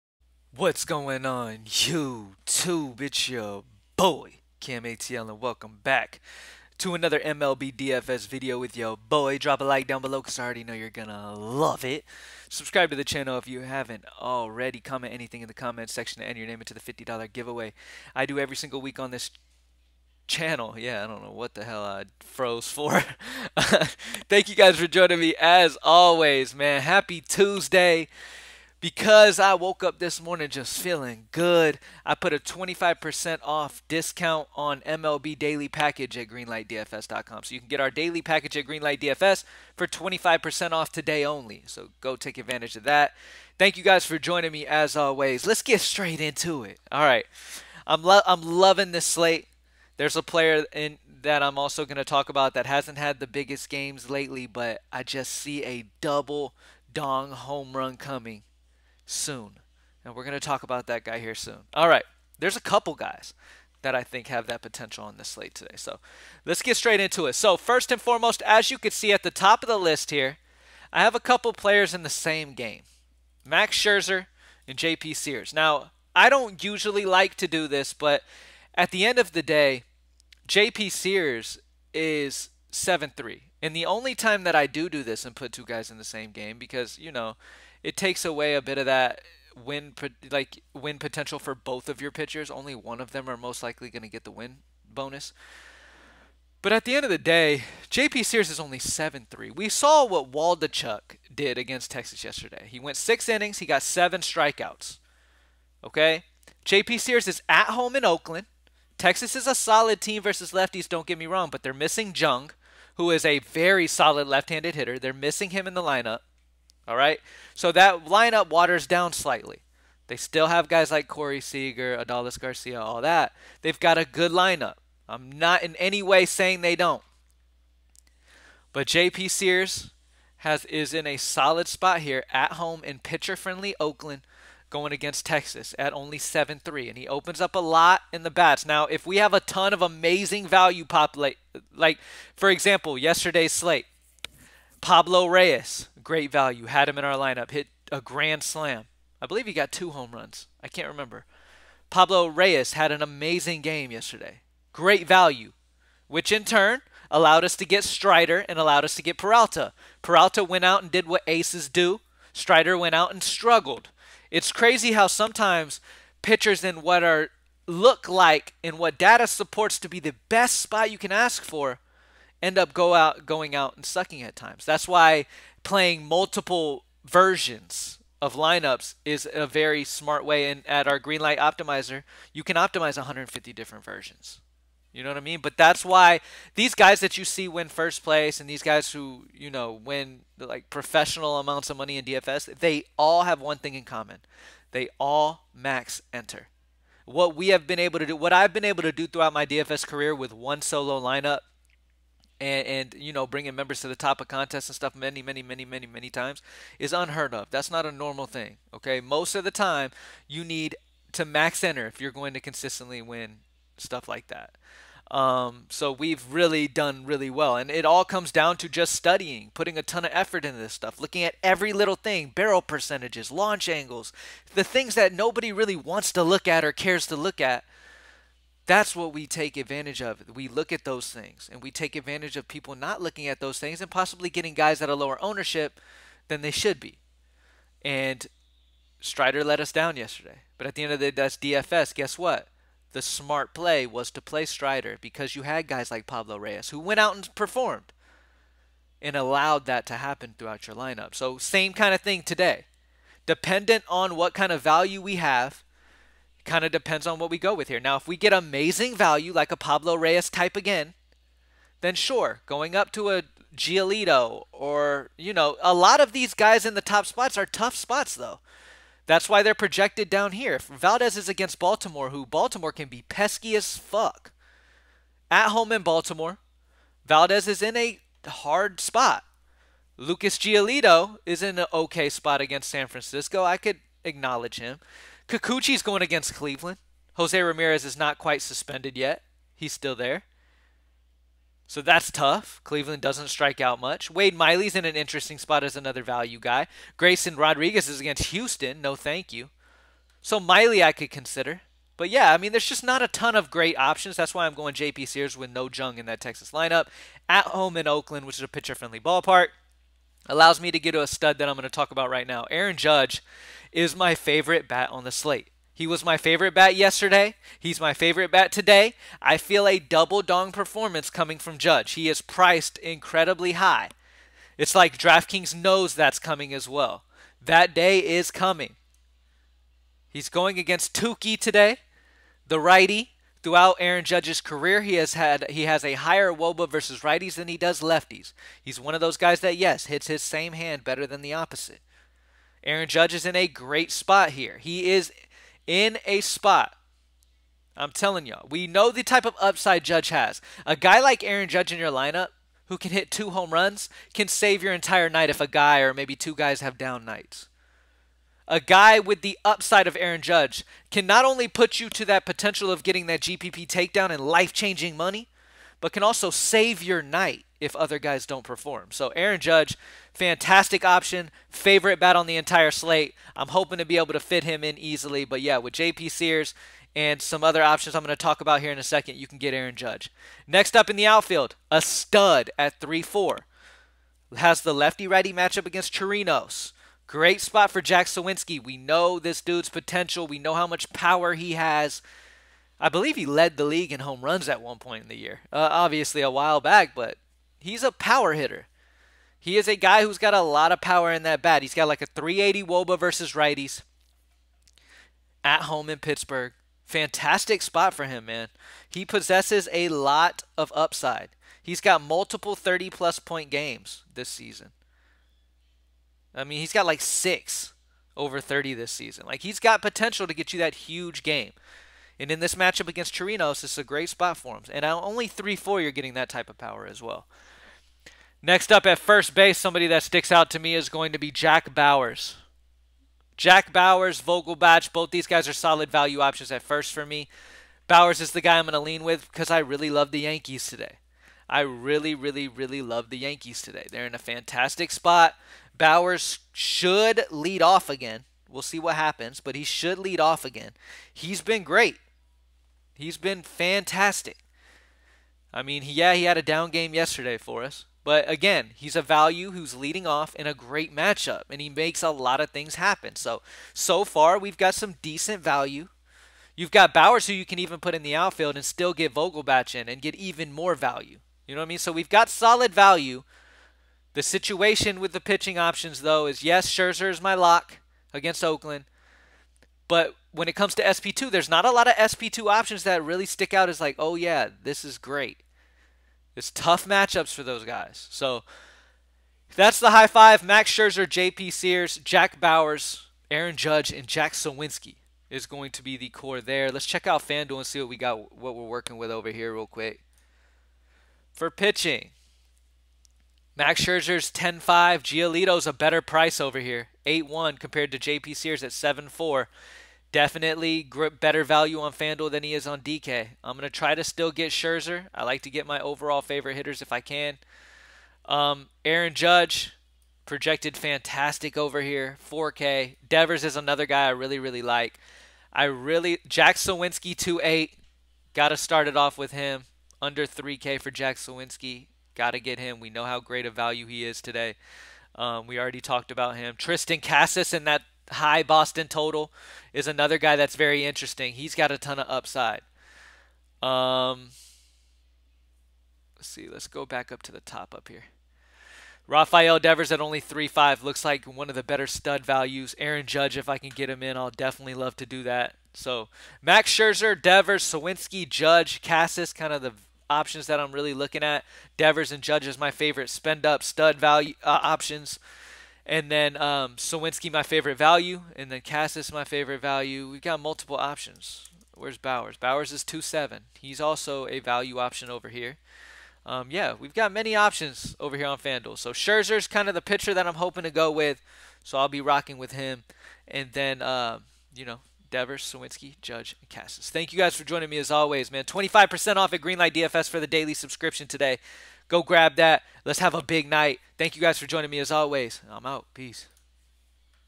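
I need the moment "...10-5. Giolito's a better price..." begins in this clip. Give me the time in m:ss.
8:24.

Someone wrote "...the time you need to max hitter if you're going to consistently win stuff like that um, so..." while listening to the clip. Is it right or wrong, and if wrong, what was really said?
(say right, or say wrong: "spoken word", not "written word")
wrong: "enter", not "hitter".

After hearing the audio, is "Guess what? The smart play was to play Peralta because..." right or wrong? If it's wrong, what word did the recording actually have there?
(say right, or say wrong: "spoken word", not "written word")
wrong: "Strider", not "Peralta".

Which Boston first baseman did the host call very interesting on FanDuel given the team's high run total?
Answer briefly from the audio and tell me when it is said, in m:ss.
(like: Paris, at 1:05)
Triston Casas, at 8:56.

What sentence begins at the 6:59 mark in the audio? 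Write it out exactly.
Like he's got potential to get you that huge game.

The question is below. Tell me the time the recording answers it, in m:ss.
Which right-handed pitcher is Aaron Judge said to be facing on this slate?
5:30.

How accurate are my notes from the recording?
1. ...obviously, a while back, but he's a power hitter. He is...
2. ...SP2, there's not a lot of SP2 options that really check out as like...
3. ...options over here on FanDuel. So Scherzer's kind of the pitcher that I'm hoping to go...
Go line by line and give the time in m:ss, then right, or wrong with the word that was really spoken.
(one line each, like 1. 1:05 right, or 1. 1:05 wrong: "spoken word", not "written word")
1. 6:35 right
2. 8:00 wrong: "stick", not "check"
3. 9:37 right.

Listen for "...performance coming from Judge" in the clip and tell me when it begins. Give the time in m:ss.
5:20.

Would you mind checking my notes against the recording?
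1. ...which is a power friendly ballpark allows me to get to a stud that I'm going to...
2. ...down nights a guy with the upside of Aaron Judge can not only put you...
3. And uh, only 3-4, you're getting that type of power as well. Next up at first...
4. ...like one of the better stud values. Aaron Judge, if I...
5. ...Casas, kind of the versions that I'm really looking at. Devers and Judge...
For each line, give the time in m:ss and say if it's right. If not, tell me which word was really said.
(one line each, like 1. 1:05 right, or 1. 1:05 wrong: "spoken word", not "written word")
1. 5:08 wrong: "pitcher", not "power"
2. 5:56 right
3. 7:04 right
4. 9:11 right
5. 9:18 wrong: "options", not "versions".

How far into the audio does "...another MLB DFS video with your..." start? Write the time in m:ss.
0:06.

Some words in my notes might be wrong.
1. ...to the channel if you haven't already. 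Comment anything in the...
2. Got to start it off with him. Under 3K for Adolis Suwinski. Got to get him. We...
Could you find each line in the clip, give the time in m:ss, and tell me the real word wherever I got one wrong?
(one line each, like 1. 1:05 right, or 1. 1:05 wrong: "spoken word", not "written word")
1. 0:12 right
2. 8:48 wrong: "Jack", not "Adolis".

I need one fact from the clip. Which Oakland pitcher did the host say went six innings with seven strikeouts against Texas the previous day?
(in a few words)
Waldichuk.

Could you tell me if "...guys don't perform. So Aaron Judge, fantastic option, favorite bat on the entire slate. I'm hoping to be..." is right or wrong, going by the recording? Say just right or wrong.
right.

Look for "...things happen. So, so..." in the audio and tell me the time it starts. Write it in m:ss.
7:42.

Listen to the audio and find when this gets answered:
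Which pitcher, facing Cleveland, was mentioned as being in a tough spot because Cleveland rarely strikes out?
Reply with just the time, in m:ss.
4:45.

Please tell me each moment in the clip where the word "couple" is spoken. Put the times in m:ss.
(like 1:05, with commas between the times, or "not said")
1:02, 1:11.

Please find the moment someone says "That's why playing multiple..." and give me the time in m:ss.
2:54.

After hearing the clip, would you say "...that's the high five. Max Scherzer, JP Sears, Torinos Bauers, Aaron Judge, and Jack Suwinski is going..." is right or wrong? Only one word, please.
wrong.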